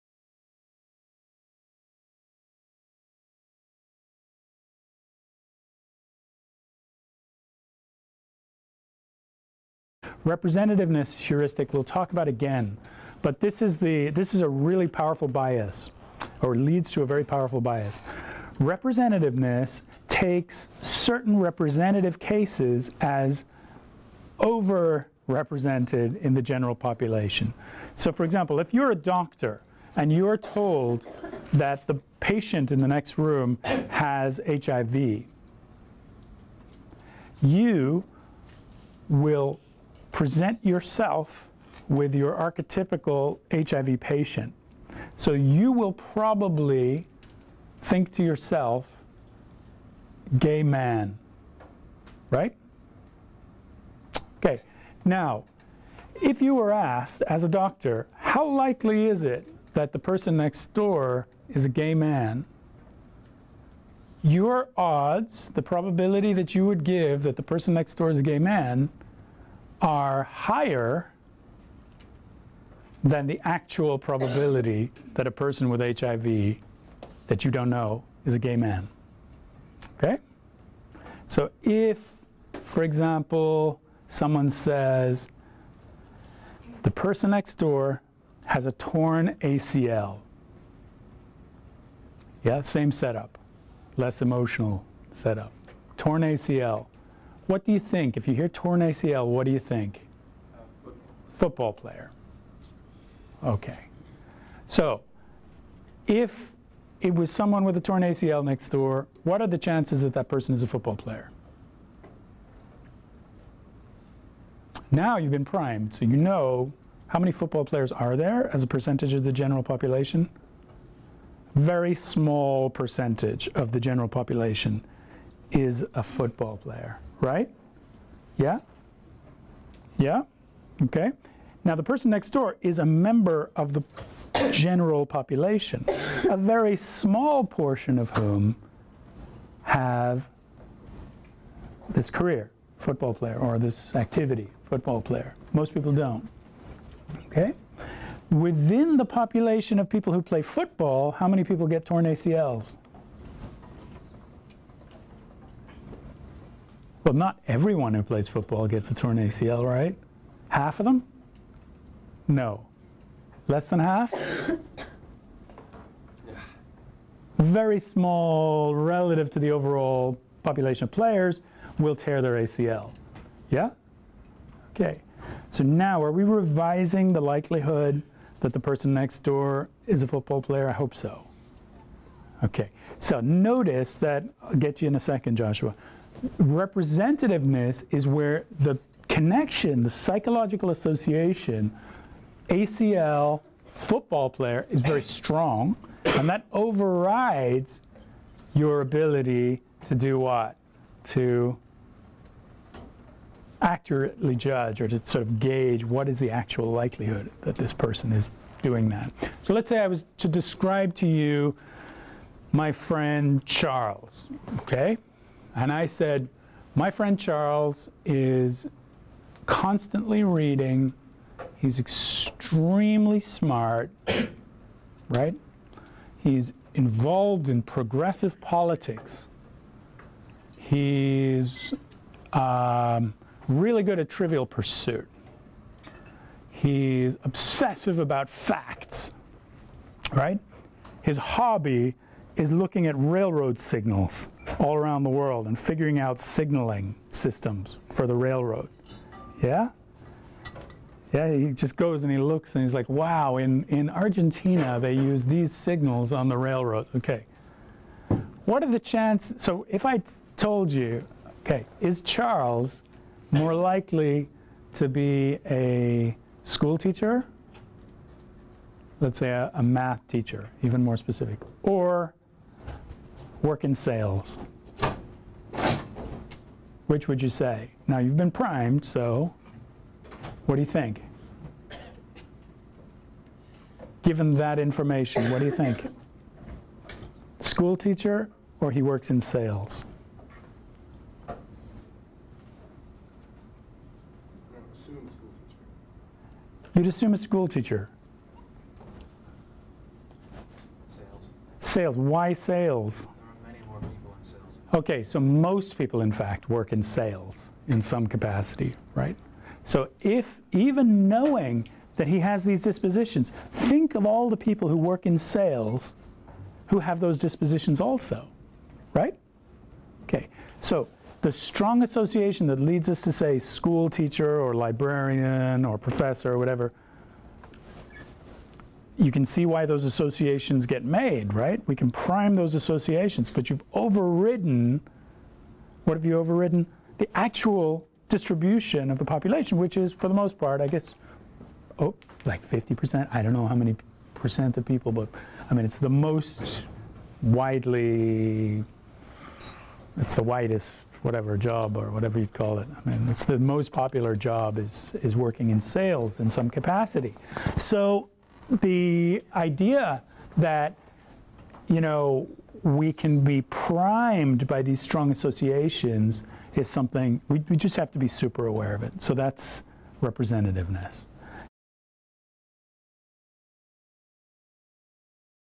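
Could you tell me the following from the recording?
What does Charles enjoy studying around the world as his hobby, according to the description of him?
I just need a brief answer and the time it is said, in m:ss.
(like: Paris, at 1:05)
railroad signals, at 4:02.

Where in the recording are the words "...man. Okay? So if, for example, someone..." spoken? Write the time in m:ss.
1:18.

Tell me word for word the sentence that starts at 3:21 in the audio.
To accurately judge or to sort of gauge what is the actual likelihood that this person is doing that.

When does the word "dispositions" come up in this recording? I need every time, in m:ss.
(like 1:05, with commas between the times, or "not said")
5:12, 5:17.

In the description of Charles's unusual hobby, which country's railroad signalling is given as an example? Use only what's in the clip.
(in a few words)
Argentina.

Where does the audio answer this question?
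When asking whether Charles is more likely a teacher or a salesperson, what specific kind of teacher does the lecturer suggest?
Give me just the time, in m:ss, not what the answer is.
4:29.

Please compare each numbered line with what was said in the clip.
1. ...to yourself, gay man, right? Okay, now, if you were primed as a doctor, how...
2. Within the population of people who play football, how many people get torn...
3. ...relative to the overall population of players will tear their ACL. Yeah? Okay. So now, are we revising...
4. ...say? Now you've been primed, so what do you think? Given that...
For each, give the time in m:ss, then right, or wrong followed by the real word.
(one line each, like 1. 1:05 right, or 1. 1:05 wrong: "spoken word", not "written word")
1. 0:48 wrong: "asked", not "primed"
2. 2:28 right
3. 2:48 right
4. 4:37 right.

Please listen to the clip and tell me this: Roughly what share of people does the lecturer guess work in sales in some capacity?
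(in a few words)
50%.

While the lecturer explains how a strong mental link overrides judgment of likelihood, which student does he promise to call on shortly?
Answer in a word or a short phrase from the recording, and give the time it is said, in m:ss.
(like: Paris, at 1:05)
Joshua, at 3:05.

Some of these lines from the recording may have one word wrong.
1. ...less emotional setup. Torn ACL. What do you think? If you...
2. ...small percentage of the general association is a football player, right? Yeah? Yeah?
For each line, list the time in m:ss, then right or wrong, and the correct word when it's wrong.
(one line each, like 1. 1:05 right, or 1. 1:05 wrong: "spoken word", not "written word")
1. 1:33 right
2. 2:01 wrong: "population", not "association".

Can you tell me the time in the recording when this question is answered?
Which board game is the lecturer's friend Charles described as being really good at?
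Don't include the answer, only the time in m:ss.
3:54.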